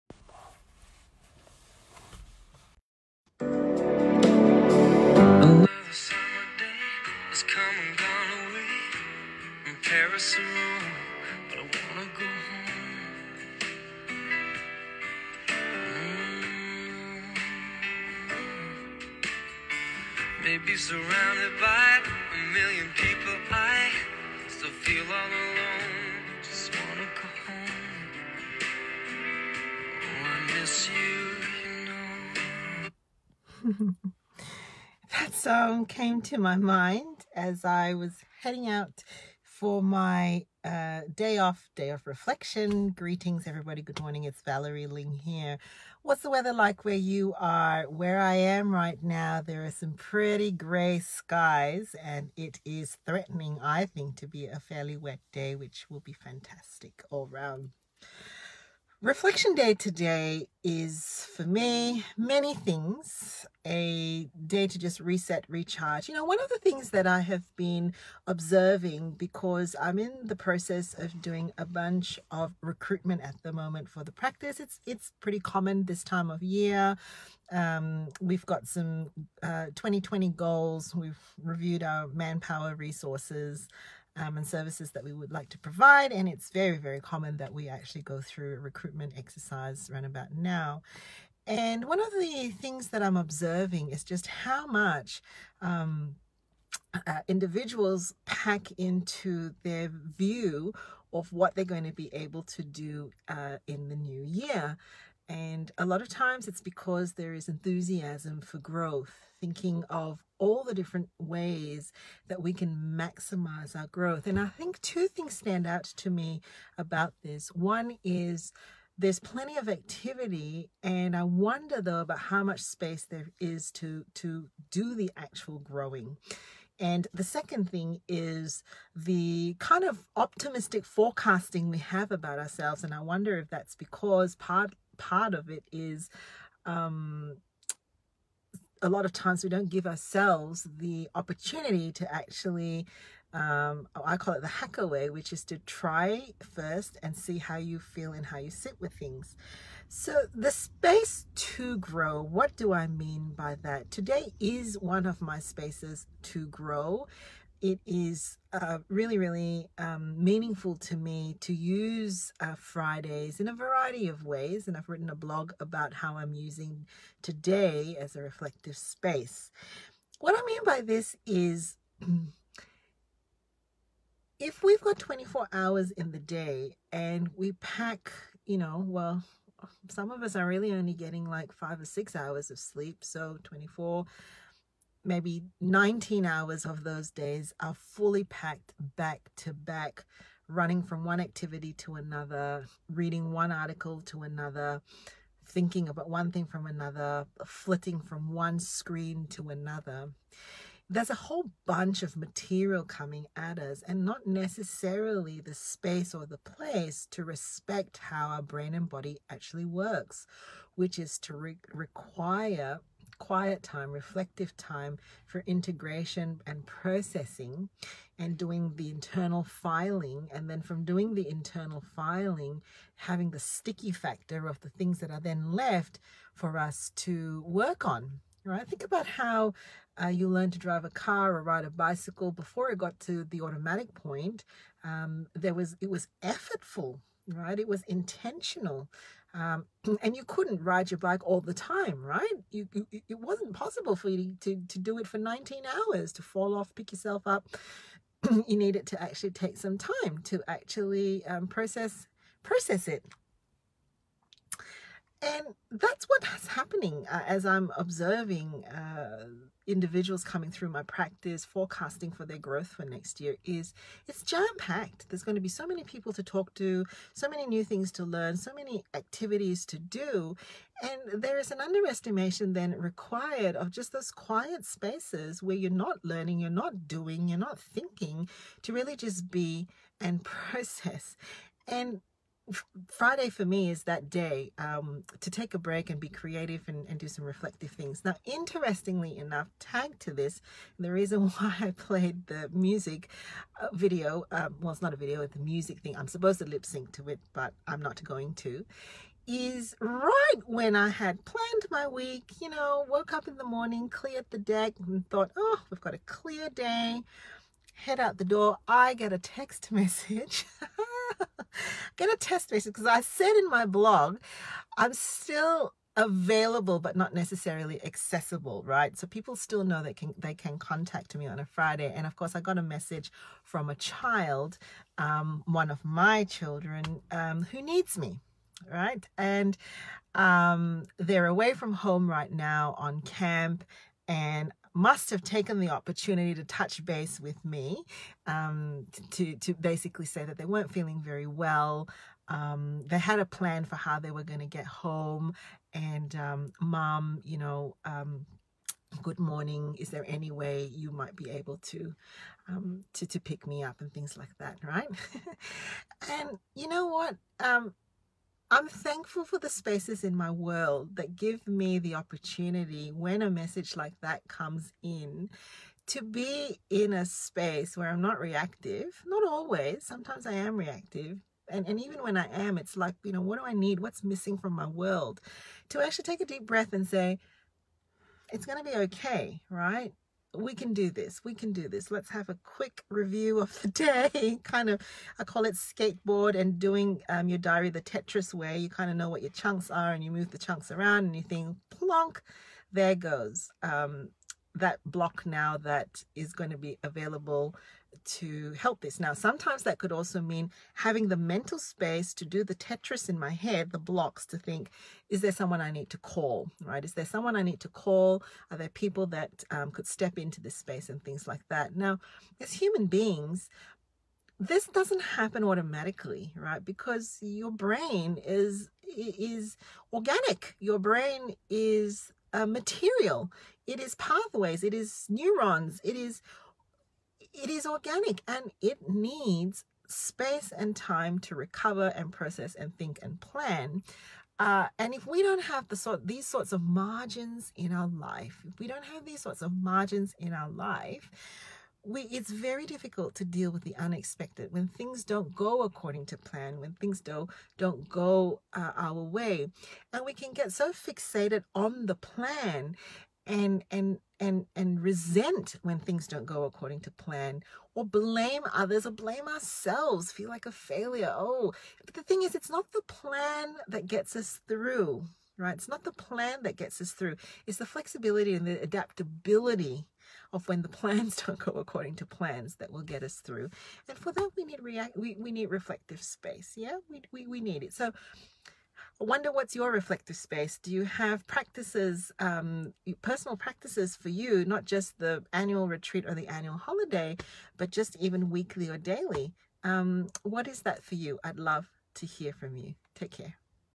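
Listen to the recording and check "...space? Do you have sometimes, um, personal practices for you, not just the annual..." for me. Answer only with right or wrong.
wrong.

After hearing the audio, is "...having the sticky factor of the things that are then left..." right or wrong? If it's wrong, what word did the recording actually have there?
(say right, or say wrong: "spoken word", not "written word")
right.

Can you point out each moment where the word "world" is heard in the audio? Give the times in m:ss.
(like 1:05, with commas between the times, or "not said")
6:00, 6:14.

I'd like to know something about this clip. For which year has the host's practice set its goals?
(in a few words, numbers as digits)
2020.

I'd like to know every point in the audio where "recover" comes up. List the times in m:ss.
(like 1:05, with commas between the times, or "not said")
7:11.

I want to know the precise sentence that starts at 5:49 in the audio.
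Is there any way you might be able to, um, to to pick me up and things like that, right?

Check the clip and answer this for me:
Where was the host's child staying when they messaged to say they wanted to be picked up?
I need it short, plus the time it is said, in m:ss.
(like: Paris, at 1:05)
camp, at 5:33.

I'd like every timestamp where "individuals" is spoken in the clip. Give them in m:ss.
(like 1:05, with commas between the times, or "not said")
1:37, 4:19.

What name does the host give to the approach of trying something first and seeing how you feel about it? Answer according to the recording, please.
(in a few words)
the hacker way.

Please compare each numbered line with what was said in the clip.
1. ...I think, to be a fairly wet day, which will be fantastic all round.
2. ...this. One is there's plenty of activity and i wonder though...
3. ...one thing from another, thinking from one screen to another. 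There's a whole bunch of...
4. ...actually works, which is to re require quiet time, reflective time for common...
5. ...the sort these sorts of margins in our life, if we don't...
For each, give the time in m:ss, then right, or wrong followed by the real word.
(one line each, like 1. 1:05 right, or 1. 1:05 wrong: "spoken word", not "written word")
1. 0:53 right
2. 1:57 right
3. 3:16 wrong: "flitting", not "thinking"
4. 3:29 wrong: "integration", not "common"
5. 7:15 right.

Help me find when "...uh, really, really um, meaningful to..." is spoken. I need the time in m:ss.
2:38.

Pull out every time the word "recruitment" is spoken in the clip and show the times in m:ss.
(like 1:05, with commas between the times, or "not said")
1:12, 1:28.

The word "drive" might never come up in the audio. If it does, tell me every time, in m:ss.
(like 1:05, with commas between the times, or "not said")
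3:50.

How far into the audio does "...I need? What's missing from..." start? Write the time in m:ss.
6:13.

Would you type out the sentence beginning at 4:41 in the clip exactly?
And Friday for me is that day um, to take a break and be creative and, and, do some reflective things.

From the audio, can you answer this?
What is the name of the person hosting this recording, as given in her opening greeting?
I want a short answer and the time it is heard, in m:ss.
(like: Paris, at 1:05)
Valerie Ling, at 0:44.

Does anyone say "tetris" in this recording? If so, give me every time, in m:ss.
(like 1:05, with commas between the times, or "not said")
6:27, 6:42.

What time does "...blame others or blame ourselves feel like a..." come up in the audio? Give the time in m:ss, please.
7:37.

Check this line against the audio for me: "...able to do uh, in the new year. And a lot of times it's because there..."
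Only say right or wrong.
right.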